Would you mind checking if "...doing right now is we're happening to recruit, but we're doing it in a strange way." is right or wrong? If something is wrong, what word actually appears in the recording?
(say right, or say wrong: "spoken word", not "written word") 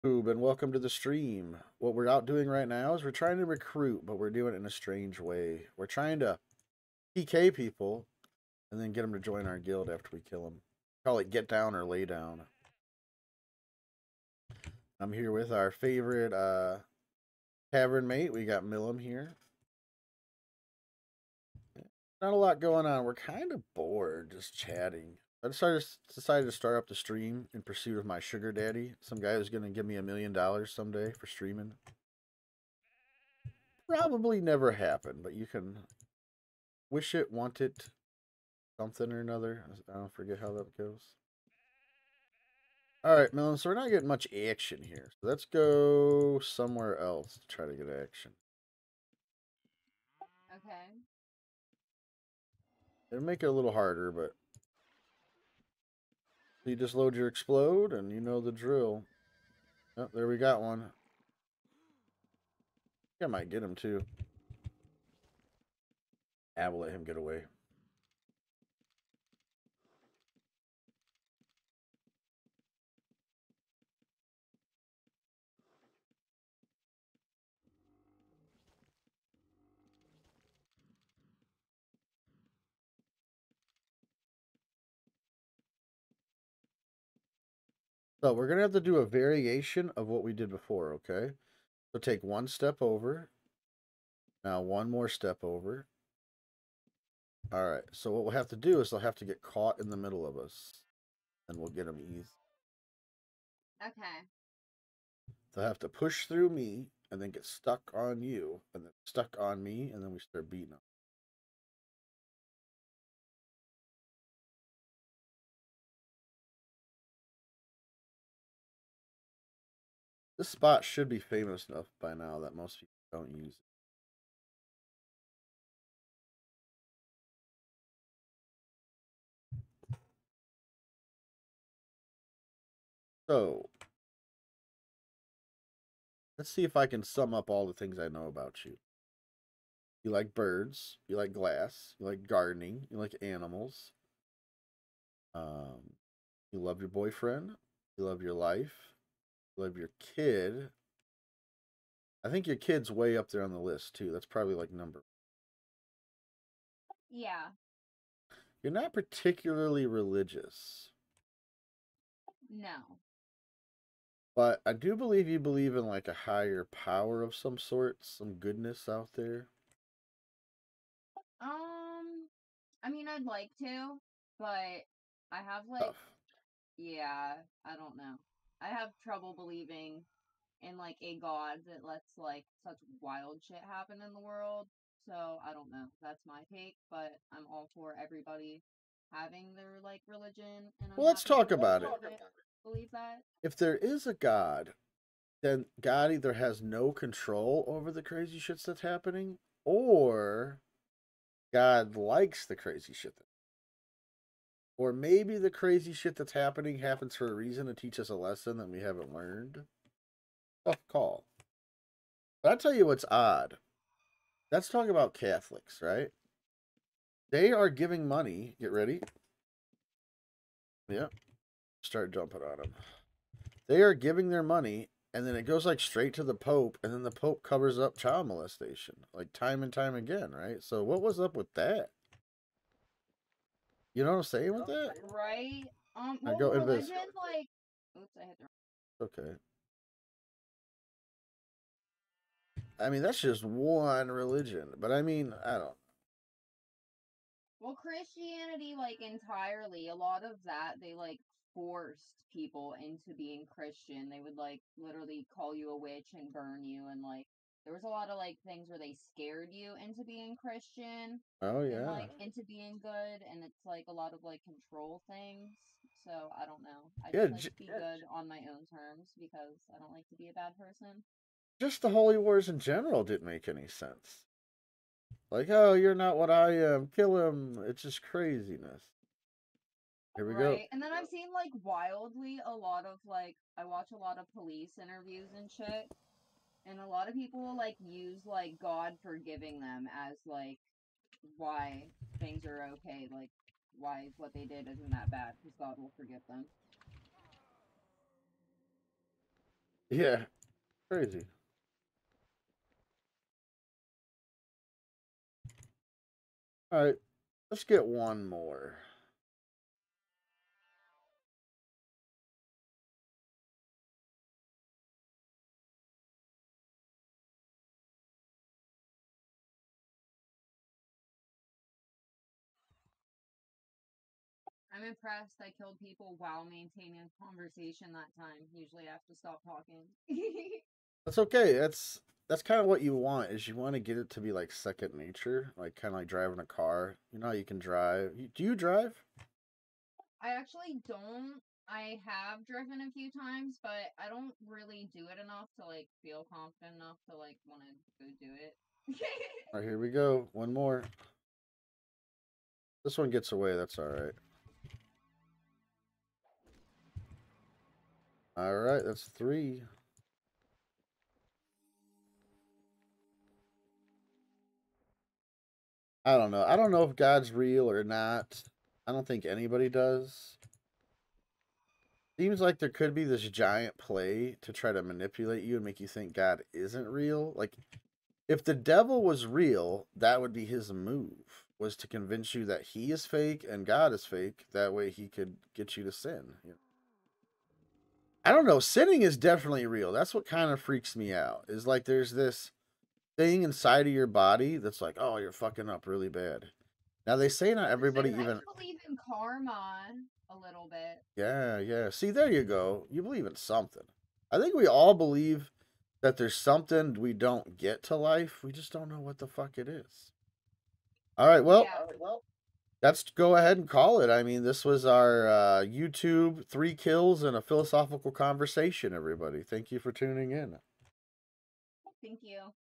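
wrong: "trying", not "happening".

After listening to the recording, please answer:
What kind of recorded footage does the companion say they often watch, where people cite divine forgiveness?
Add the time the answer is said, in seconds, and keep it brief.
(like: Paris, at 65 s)
Police interviews, at 284 s.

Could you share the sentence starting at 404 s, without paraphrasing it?
I think we all believe that there's something we don't get to life.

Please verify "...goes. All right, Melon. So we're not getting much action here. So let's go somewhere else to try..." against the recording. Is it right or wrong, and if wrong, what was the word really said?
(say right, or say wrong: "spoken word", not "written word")
right.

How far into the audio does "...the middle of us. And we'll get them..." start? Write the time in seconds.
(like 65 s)
99 s.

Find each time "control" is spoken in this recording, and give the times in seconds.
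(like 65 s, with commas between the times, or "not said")
196 s, 264 s.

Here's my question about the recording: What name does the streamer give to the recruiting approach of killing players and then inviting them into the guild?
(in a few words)
Get down or lay down.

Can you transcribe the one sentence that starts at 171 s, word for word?
Um, I mean, I'd like to, but I have like, Tough.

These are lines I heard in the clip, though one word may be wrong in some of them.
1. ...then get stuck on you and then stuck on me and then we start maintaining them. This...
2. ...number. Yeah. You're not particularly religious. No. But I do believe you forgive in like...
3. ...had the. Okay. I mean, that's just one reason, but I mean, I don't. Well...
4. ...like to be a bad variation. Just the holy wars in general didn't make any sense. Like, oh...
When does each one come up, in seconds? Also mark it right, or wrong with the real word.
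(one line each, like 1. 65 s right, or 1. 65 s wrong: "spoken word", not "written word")
1. 107 s wrong: "beating", not "maintaining"
2. 154 s wrong: "believe", not "forgive"
3. 238 s wrong: "religion", not "reason"
4. 269 s wrong: "person", not "variation".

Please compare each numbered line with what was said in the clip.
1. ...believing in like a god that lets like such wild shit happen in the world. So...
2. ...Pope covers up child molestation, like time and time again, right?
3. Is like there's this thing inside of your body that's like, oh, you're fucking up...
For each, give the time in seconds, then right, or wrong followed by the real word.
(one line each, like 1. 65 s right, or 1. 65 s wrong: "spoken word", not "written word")
1. 179 s right
2. 227 s right
3. 391 s right.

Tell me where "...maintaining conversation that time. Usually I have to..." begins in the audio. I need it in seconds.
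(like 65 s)
326 s.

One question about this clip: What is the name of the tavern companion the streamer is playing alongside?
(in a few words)
Millum.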